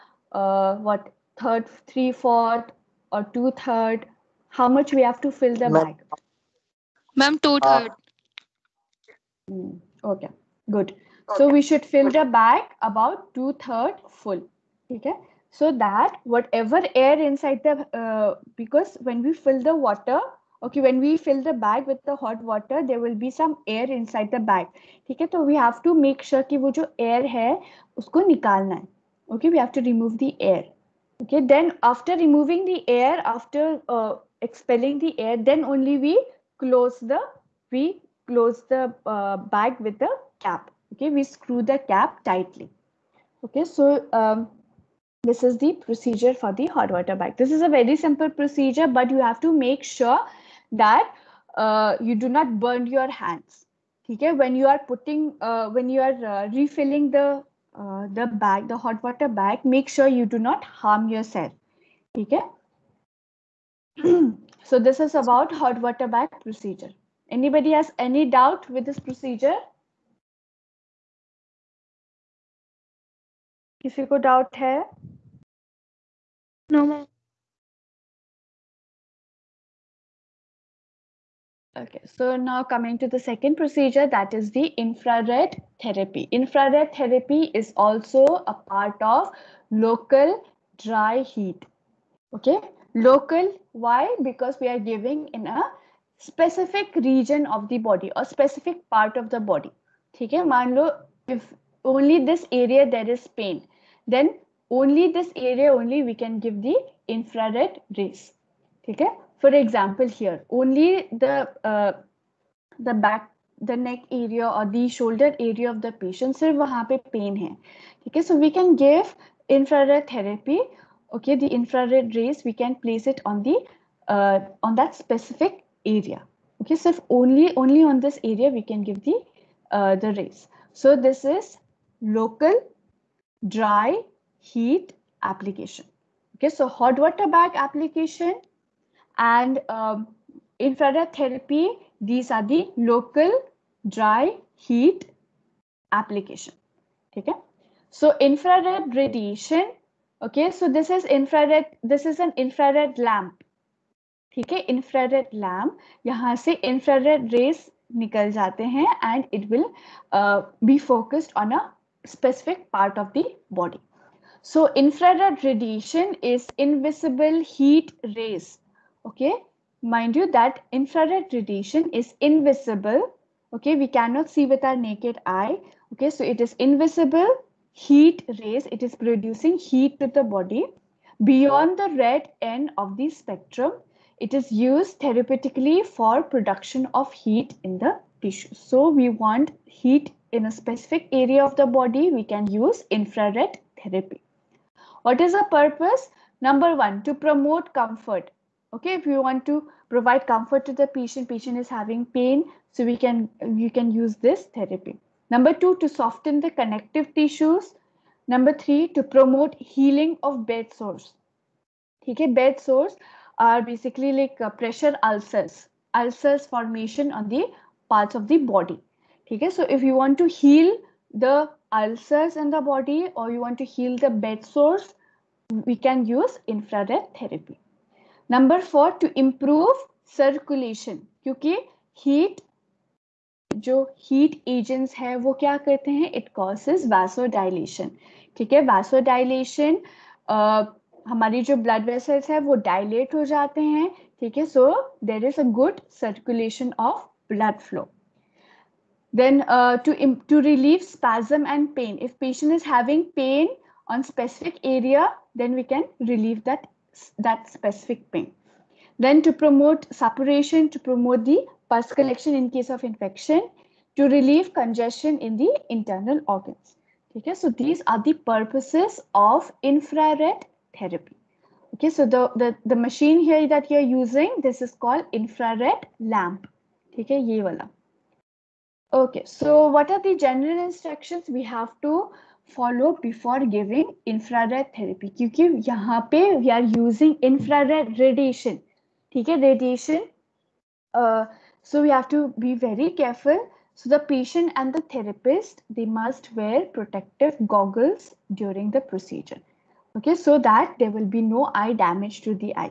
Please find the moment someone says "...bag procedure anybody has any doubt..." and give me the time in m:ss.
1:06.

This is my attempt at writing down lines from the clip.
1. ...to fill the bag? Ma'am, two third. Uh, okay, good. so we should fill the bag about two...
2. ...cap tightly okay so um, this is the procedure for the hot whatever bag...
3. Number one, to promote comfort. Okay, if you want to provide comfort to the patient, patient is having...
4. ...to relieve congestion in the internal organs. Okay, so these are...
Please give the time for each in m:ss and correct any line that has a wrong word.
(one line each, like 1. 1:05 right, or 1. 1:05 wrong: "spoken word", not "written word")
1. 0:05 right
2. 0:41 wrong: "water", not "whatever"
3. 3:16 right
4. 4:23 right.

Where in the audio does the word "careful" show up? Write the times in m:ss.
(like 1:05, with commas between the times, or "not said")
4:52.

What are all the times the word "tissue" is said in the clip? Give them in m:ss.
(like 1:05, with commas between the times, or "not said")
3:08, 3:27.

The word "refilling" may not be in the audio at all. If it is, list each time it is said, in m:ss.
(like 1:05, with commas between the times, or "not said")
0:56.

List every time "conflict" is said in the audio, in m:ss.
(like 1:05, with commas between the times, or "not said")
not said.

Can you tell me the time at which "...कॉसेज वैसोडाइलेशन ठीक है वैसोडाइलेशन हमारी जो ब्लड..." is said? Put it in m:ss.
3:56.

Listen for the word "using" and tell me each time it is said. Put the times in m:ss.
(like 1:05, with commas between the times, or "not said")
4:33, 4:46.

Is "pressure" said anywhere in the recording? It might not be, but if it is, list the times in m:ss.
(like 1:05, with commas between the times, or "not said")
3:34.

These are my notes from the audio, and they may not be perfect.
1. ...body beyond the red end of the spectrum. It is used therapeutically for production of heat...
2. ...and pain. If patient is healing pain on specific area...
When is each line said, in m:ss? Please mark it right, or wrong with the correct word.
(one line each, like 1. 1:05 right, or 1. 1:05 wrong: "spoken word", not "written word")
1. 3:00 right
2. 4:11 wrong: "having", not "healing".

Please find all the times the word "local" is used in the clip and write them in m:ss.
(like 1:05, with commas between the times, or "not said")
2:12, 2:22.